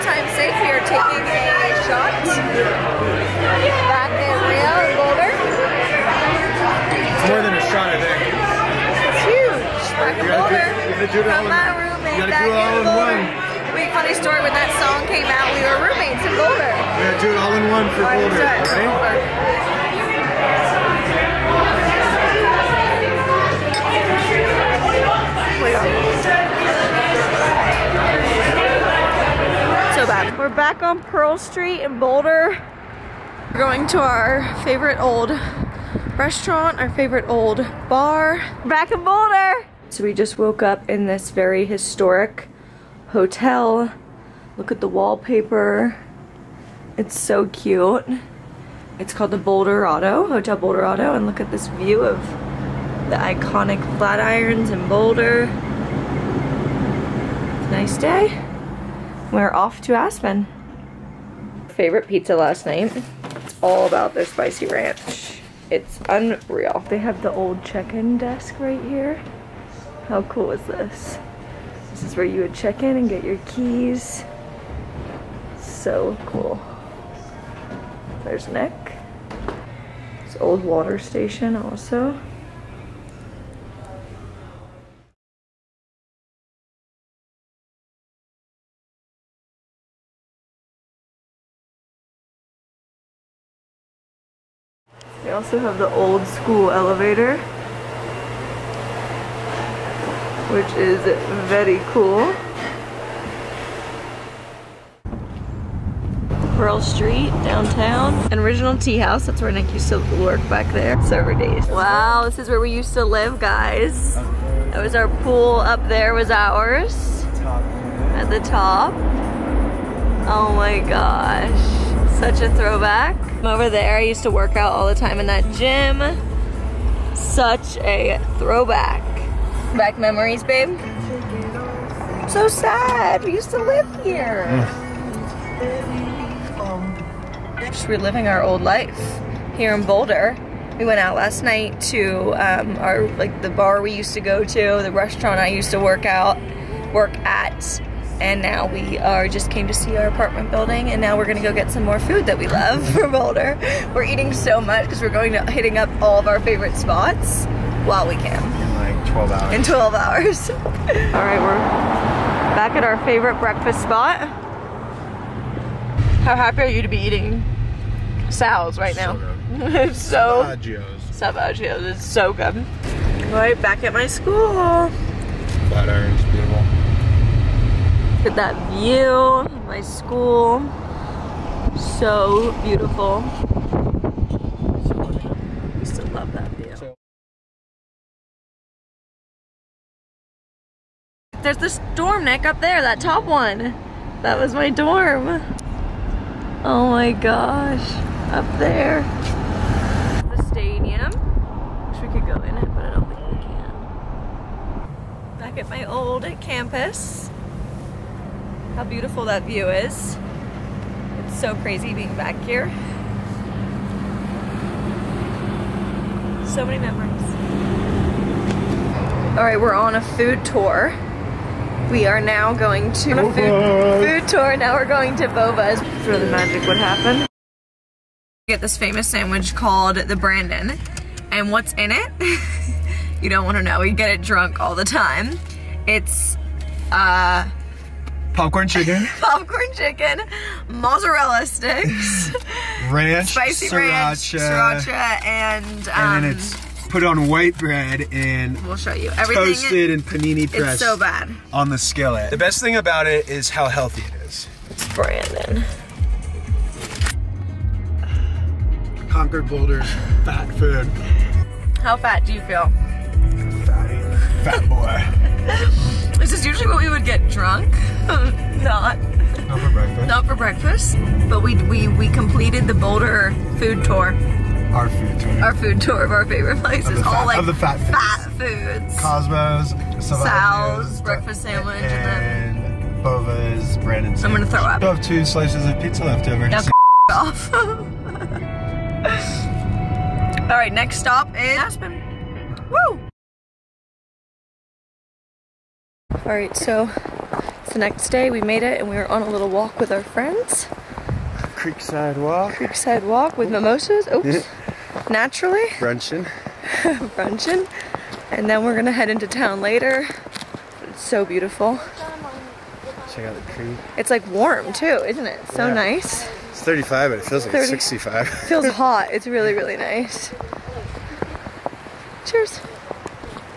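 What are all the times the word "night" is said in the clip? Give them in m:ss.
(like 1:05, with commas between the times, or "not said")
1:02, 2:21.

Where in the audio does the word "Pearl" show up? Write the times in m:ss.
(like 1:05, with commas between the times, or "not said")
0:31, 1:46.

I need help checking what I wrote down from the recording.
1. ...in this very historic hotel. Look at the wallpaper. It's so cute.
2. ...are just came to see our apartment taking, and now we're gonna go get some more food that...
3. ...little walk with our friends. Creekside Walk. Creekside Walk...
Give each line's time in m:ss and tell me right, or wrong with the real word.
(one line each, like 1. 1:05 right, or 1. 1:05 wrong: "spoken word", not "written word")
1. 0:40 right
2. 2:28 wrong: "building", not "taking"
3. 4:59 right.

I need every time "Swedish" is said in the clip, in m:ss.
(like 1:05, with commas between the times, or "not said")
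not said.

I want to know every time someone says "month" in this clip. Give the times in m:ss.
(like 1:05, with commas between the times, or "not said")
not said.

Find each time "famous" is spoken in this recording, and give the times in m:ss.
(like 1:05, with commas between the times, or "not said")
3:48.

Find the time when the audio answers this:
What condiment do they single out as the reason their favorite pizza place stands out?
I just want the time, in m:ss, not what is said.
1:04.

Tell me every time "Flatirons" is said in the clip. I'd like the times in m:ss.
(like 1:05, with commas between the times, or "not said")
0:53, 2:55.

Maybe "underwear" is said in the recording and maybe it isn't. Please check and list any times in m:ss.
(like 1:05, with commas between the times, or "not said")
not said.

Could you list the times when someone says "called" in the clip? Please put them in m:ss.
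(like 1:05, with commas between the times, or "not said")
0:49, 3:49.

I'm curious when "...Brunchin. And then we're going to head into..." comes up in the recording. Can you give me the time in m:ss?
5:07.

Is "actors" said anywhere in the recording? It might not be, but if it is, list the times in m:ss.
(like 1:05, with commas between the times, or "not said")
not said.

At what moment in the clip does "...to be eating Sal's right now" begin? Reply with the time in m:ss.
2:46.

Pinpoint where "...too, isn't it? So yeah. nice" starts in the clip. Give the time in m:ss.
5:14.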